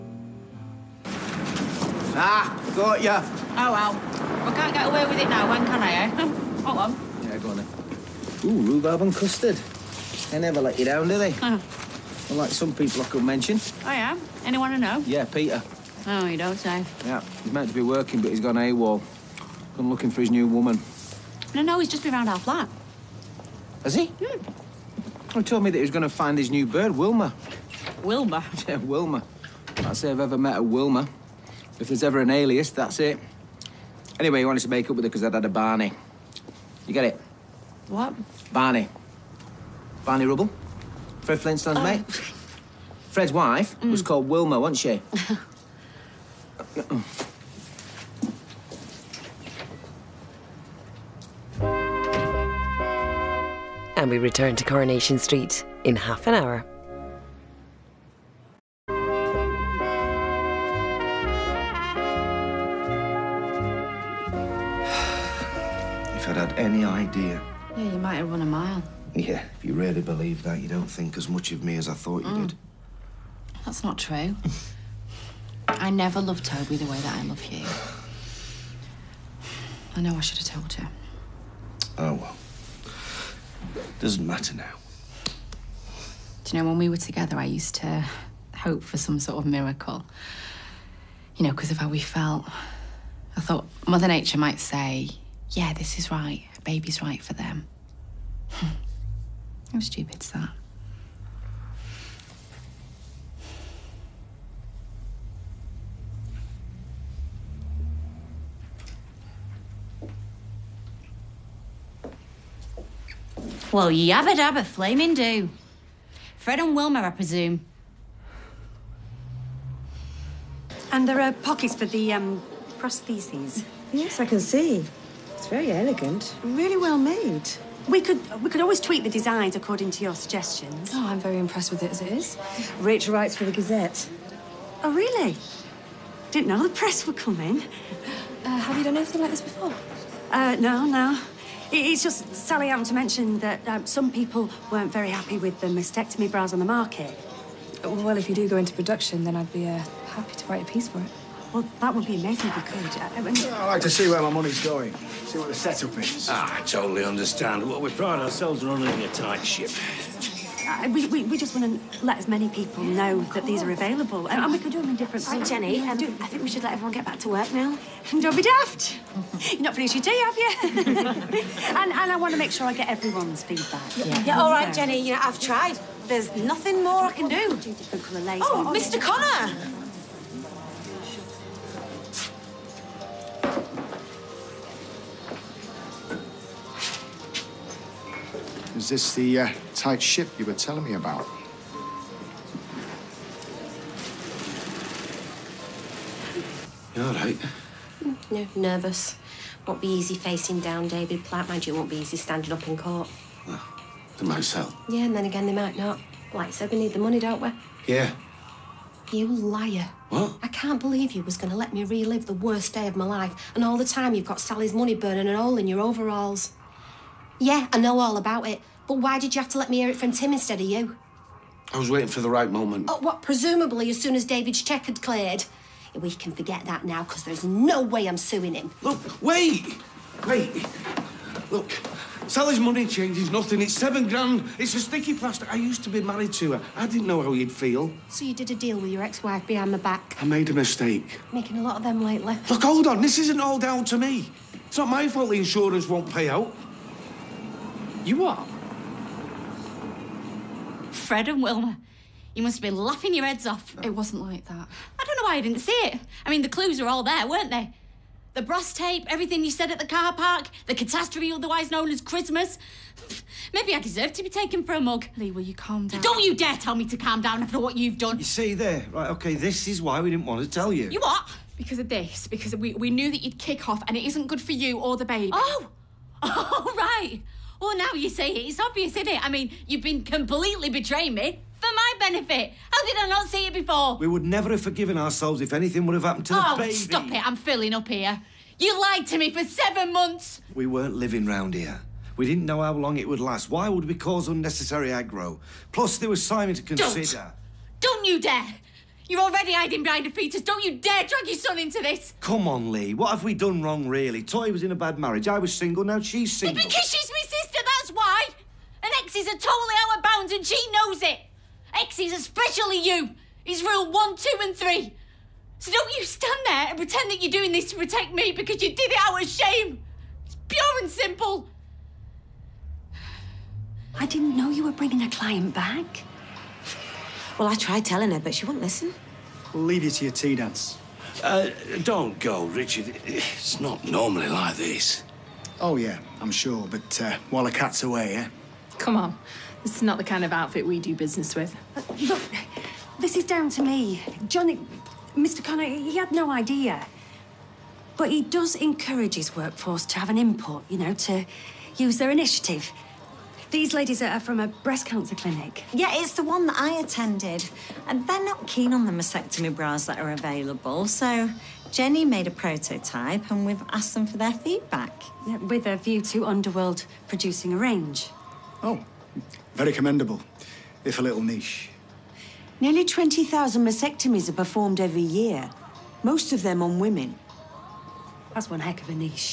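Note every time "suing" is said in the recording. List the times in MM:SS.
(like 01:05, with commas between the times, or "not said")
03:48.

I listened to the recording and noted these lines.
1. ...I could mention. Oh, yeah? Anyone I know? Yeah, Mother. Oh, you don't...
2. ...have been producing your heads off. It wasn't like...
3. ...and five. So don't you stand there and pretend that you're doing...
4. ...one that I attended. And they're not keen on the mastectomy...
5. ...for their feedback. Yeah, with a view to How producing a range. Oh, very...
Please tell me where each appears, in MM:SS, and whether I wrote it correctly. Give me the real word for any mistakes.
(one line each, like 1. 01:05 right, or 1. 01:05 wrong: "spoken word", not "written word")
1. 00:13 wrong: "Peter", not "Mother"
2. 04:12 wrong: "laughing", not "producing"
3. 05:14 wrong: "three", not "five"
4. 05:56 right
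5. 06:04 wrong: "Underworld", not "How".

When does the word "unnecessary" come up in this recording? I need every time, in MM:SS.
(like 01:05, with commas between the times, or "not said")
04:54.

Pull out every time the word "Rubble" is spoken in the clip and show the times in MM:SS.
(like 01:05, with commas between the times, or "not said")
00:40.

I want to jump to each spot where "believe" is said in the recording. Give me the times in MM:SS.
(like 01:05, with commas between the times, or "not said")
01:10, 03:30.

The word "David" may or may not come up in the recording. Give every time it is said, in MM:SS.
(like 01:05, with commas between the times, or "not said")
03:20, 03:44.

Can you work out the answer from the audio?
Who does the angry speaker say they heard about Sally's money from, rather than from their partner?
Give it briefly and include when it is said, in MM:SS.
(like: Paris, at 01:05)
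Tim, at 03:40.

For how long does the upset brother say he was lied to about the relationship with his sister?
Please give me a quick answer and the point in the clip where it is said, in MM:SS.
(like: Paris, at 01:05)
7 months, at 04:49.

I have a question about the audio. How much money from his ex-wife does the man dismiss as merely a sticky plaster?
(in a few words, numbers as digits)
7 grand.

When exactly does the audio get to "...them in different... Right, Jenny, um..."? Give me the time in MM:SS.
02:44.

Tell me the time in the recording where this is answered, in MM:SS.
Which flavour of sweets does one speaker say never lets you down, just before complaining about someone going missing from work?
00:08.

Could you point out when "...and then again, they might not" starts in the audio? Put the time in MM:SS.
03:25.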